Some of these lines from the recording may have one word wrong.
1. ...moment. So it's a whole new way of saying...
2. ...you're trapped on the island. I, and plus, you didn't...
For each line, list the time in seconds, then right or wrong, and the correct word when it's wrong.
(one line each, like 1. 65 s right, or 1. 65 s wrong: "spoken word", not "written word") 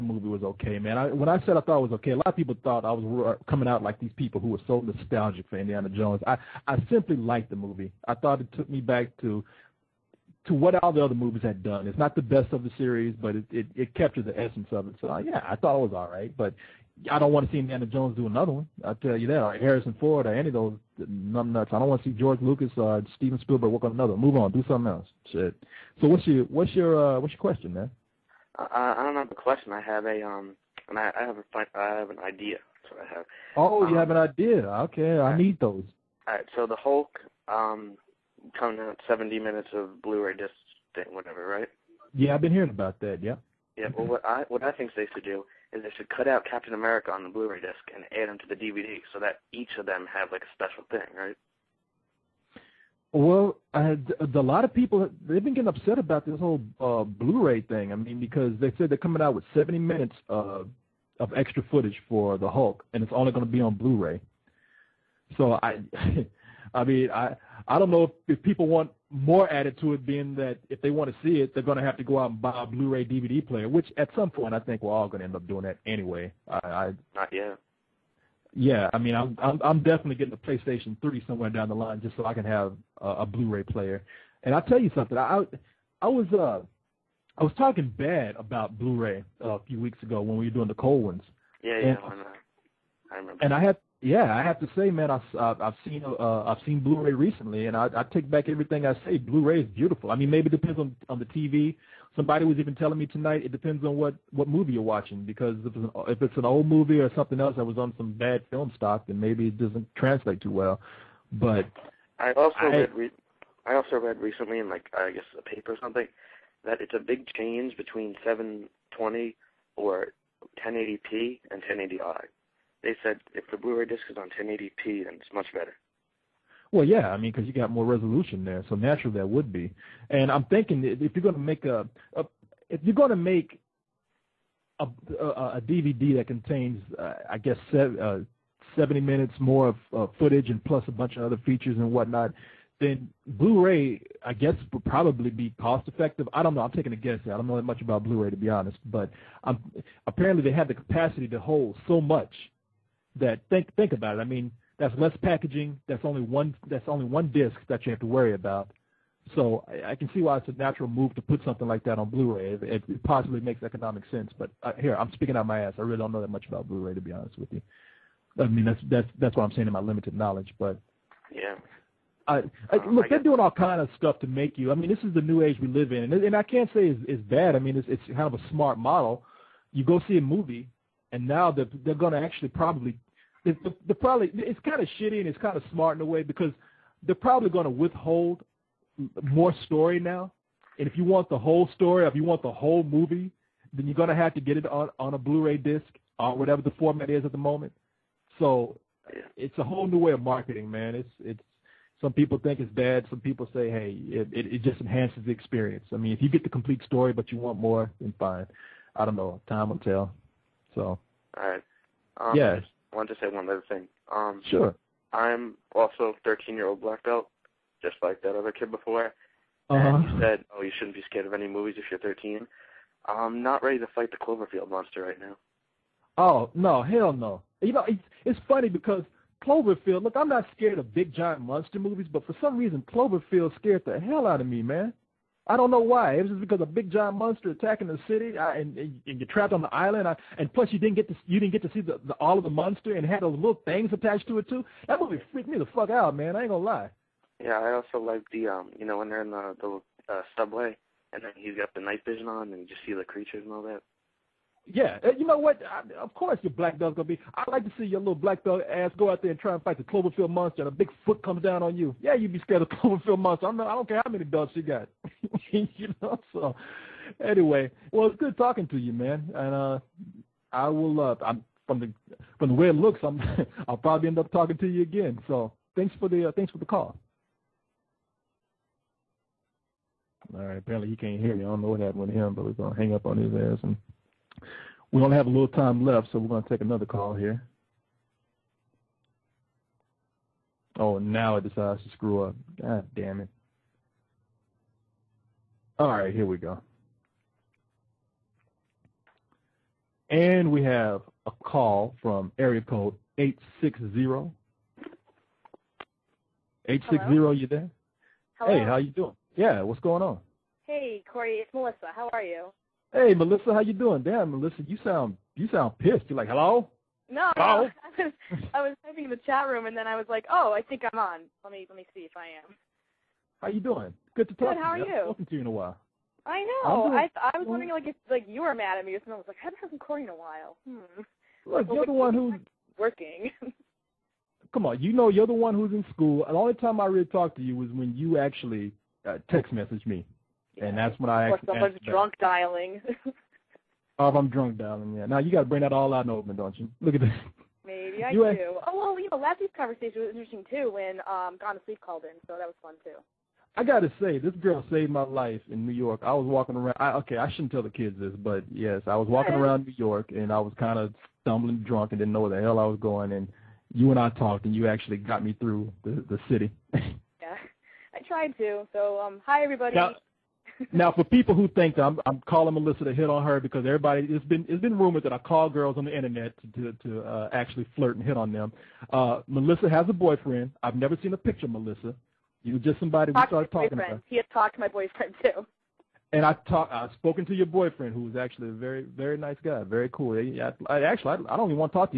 1. 197 s wrong: "marketing", not "saying"
2. 239 s right.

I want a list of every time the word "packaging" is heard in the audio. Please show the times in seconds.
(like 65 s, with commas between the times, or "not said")
155 s.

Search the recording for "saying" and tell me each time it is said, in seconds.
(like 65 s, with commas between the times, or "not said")
169 s.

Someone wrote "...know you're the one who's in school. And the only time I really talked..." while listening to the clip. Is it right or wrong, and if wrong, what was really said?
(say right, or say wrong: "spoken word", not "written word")
right.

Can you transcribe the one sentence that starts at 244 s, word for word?
That movie freaked me the fuck out, man.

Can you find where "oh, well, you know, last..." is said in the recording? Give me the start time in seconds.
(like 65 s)
348 s.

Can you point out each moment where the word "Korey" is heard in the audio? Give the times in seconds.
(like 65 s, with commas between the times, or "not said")
311 s, 329 s.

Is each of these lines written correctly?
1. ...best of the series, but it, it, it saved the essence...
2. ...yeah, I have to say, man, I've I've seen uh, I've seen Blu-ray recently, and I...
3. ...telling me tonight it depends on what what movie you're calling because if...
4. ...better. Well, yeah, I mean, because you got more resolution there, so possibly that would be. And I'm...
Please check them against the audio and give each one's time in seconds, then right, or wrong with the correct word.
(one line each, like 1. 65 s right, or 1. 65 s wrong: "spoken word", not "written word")
1. 12 s wrong: "captured", not "saved"
2. 94 s right
3. 102 s wrong: "watching", not "calling"
4. 125 s wrong: "naturally", not "possibly".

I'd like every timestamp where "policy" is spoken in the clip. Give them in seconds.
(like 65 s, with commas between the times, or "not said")
not said.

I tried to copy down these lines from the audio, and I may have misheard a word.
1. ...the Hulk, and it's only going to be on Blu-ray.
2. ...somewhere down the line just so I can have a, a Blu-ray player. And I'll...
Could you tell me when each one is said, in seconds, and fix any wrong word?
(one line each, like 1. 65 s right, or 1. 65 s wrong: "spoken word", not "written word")
1. 62 s right
2. 81 s right.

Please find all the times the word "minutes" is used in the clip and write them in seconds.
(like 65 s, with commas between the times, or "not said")
39 s, 59 s, 139 s.